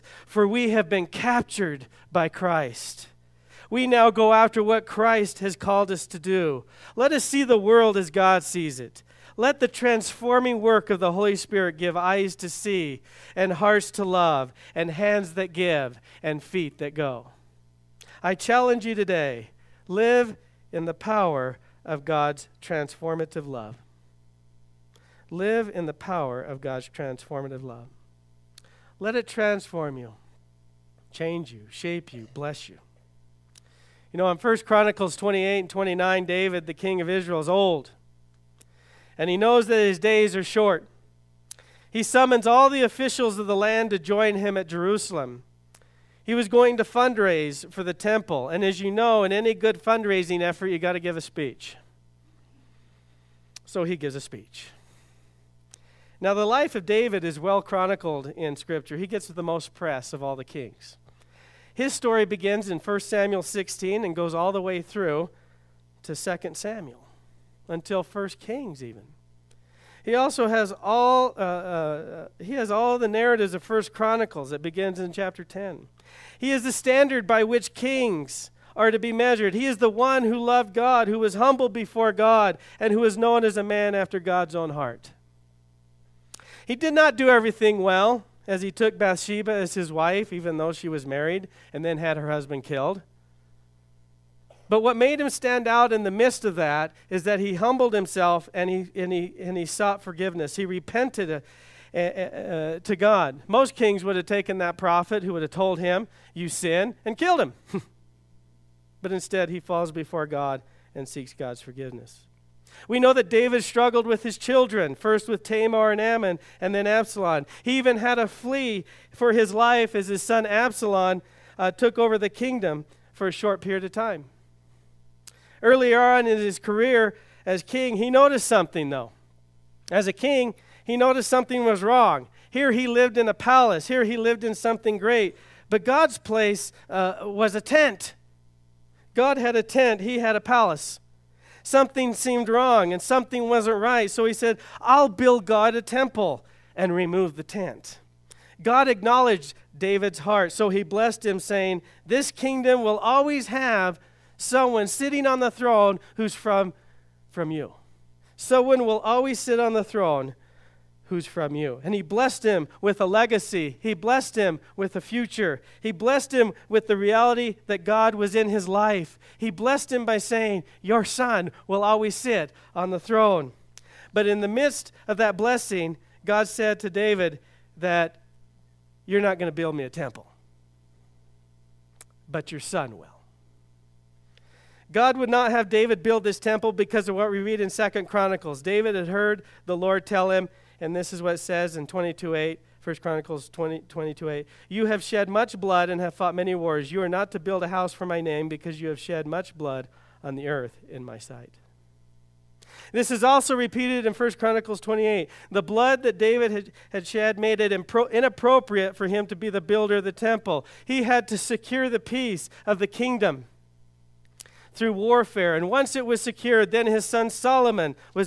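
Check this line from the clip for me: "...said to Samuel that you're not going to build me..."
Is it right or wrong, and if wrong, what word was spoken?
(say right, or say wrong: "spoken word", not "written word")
wrong: "David", not "Samuel".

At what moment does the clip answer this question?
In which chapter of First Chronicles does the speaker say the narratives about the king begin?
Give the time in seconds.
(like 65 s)
75 s.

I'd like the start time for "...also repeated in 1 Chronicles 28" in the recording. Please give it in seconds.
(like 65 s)
203 s.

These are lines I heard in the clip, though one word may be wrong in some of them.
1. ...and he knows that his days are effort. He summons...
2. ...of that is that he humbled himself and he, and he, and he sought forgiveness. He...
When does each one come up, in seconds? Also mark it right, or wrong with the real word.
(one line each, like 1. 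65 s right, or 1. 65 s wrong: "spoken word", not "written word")
1. 39 s wrong: "short", not "effort"
2. 96 s right.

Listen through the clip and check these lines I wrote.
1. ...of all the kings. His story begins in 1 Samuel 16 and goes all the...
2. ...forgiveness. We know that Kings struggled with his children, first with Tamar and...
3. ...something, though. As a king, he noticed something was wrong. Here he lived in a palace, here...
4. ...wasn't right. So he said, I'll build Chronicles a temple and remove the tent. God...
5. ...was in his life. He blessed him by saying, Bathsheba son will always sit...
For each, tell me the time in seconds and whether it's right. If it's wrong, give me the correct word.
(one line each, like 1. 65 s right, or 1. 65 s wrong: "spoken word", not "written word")
1. 60 s right
2. 111 s wrong: "David", not "Kings"
3. 128 s right
4. 143 s wrong: "God", not "Chronicles"
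5. 168 s wrong: "Your", not "Bathsheba".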